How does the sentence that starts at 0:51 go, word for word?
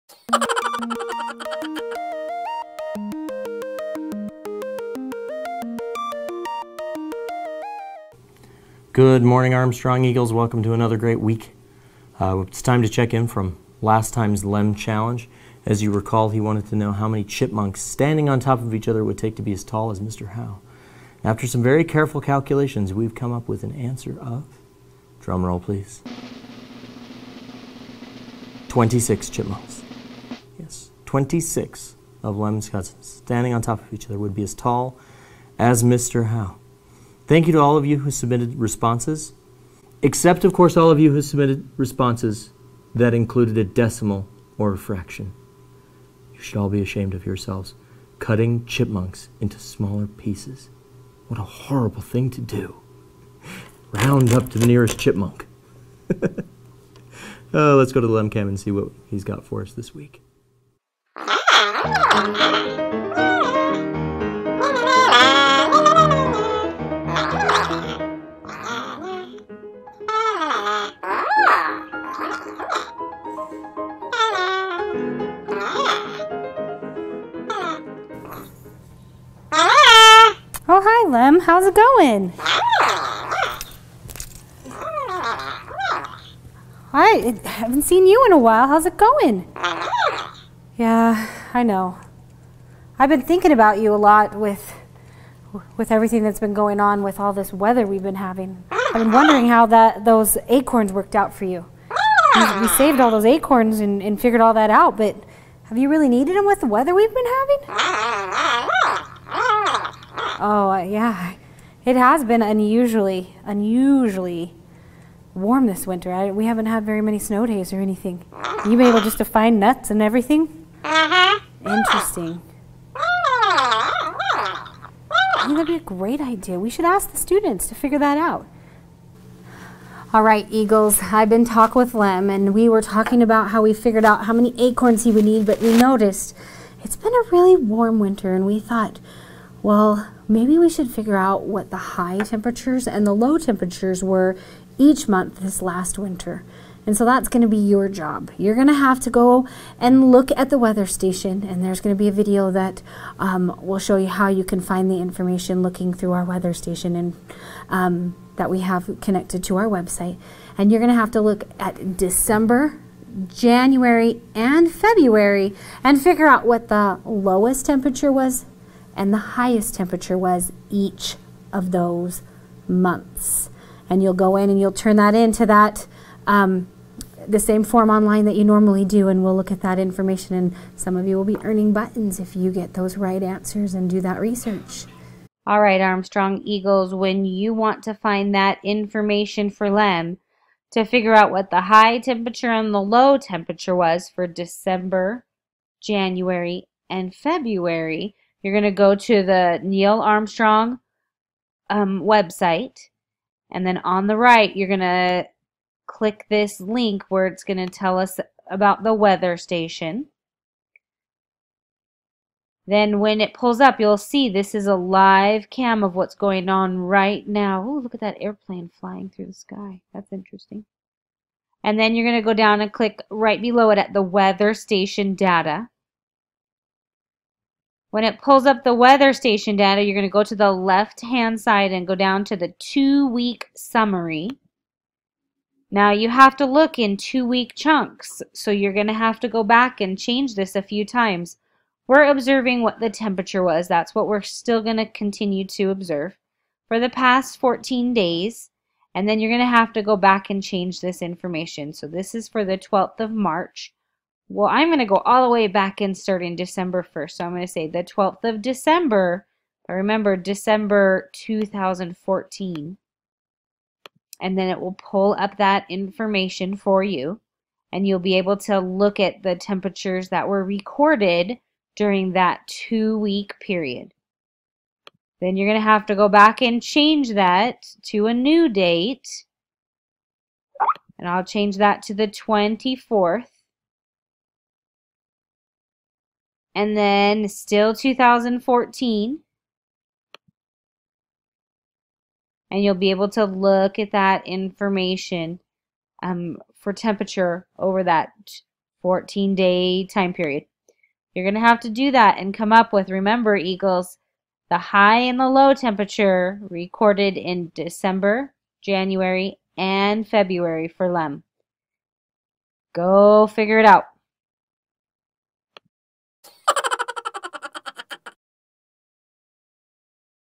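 What a horrible thing to do.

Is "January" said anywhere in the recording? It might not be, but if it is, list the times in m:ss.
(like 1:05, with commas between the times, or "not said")
2:43, 3:15, 5:08.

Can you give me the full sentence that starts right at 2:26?
And so that's going to be your job.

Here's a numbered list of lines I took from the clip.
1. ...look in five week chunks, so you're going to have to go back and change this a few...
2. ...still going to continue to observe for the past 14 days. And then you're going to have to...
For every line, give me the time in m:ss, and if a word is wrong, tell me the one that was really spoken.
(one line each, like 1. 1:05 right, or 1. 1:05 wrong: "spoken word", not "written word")
1. 3:56 wrong: "two", not "five"
2. 4:04 right.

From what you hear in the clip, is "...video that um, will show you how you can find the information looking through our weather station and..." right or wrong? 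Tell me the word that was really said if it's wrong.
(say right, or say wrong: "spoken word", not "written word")
right.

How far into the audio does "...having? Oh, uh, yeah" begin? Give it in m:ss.
1:47.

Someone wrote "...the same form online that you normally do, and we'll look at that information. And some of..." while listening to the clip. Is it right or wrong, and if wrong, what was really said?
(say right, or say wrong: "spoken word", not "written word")
right.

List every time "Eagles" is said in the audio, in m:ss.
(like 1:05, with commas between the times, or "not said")
0:10, 2:10, 3:06, 5:03.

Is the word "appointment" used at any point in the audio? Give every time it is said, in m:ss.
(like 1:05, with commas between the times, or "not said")
not said.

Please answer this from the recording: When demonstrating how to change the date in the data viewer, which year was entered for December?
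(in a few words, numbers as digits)
2014.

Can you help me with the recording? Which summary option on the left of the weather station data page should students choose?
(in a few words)
two-week summary.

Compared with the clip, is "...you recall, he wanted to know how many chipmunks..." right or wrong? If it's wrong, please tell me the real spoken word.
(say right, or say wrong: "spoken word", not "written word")
right.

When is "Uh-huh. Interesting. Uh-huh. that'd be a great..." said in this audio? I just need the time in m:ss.
2:00.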